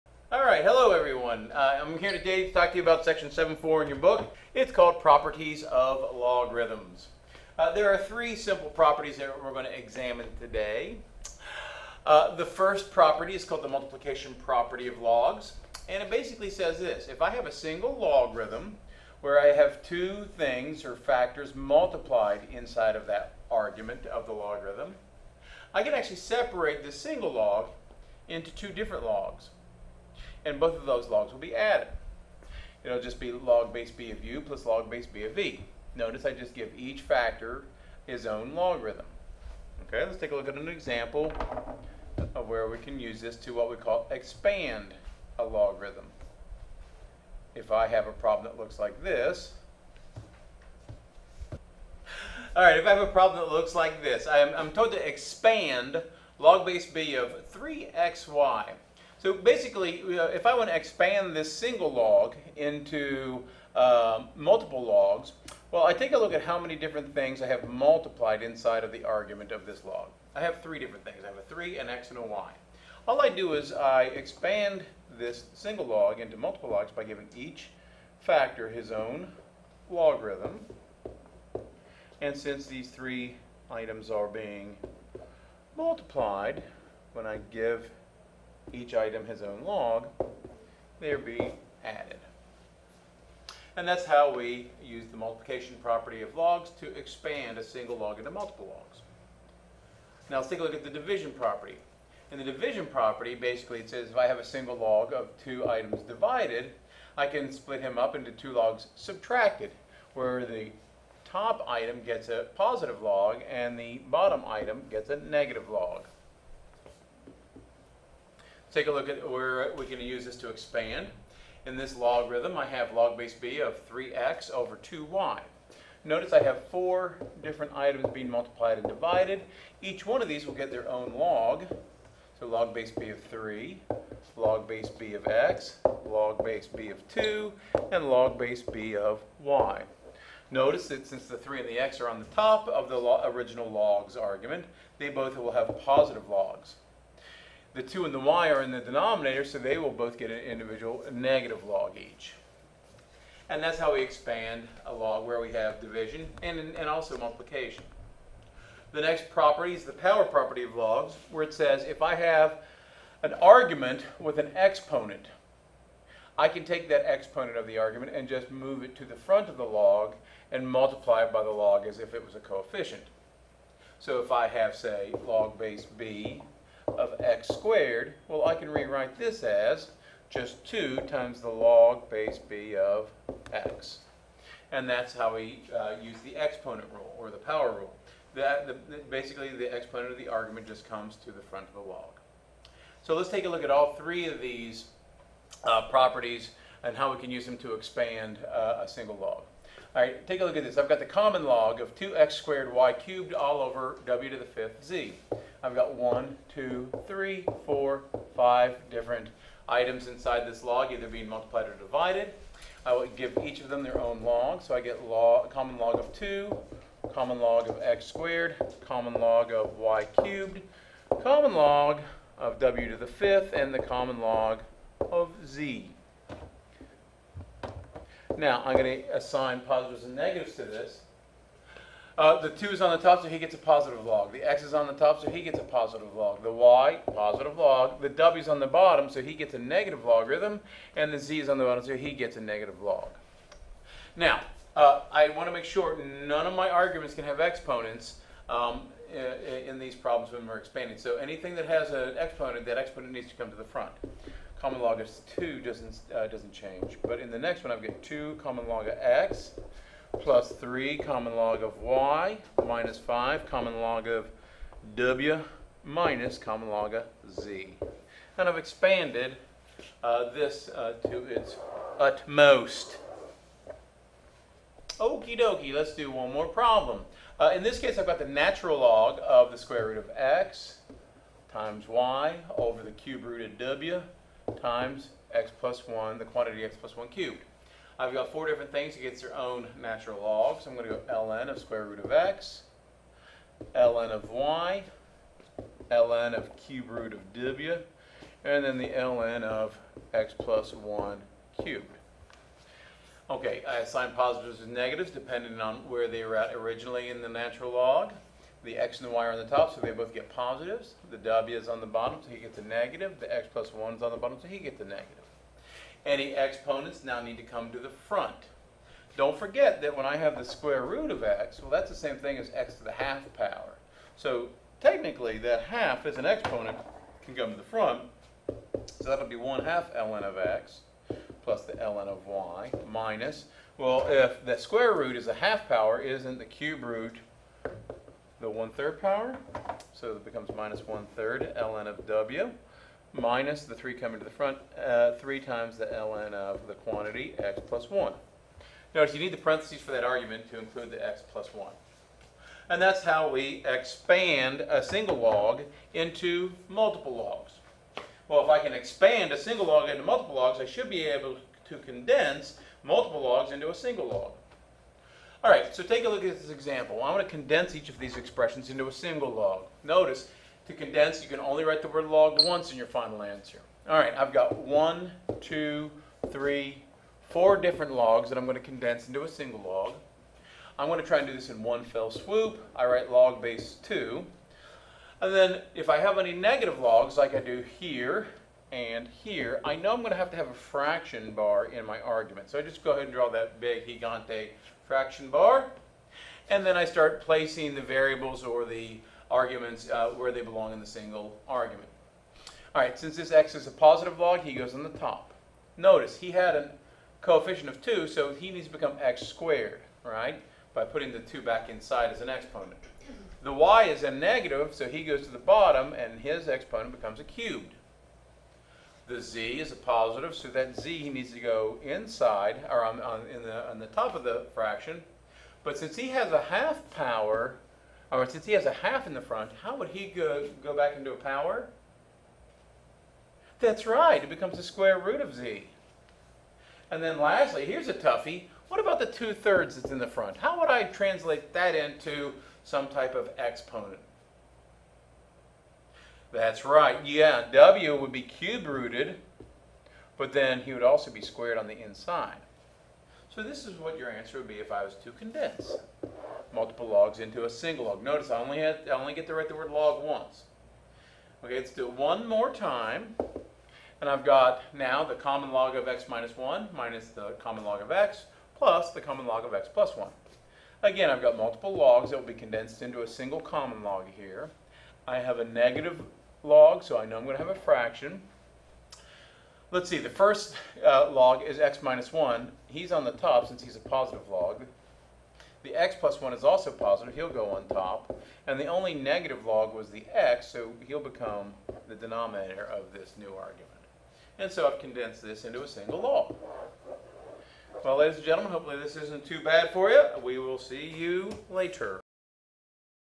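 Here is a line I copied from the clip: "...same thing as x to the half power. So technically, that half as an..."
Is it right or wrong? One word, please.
right.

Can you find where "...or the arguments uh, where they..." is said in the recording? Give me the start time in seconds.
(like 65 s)
398 s.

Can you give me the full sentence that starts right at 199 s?
All right, take a look at this.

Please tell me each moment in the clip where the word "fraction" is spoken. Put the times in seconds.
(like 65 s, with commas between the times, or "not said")
390 s, 394 s, 424 s, 477 s.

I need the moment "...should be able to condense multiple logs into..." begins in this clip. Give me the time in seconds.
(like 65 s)
360 s.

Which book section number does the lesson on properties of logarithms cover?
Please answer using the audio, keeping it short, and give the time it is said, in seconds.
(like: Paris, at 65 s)
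7.4, at 3 s.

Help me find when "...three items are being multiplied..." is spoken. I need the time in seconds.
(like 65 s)
82 s.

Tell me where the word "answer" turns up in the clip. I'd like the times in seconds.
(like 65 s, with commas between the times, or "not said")
373 s, 454 s.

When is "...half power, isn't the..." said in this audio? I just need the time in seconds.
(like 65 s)
335 s.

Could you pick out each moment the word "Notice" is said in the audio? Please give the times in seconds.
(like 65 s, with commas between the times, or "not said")
35 s, 126 s, 140 s, 348 s, 369 s, 405 s, 458 s.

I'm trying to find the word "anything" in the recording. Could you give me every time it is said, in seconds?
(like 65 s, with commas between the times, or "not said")
251 s.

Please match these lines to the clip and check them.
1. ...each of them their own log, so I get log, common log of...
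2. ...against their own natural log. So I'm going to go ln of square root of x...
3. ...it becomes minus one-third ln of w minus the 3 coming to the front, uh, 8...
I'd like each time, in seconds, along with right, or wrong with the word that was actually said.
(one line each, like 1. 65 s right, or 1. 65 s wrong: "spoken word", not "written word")
1. 213 s right
2. 288 s right
3. 340 s wrong: "3", not "8".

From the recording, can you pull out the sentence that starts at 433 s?
That's right, it becomes the square root of z.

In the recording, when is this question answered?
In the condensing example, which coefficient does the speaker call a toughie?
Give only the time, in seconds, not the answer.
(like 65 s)
439 s.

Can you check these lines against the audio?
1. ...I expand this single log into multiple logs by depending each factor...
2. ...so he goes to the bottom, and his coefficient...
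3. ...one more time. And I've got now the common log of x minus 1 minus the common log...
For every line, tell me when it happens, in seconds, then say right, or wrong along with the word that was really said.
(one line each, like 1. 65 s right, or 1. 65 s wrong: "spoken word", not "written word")
1. 73 s wrong: "giving", not "depending"
2. 414 s wrong: "exponent", not "coefficient"
3. 461 s right.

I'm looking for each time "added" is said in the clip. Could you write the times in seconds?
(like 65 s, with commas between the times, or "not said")
31 s, 91 s.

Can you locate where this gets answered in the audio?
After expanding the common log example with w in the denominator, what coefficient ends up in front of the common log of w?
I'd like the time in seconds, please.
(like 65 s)
262 s.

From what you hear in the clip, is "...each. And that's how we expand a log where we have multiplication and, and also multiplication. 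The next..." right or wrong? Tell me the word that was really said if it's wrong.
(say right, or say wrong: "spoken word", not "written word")
wrong: "division", not "multiplication".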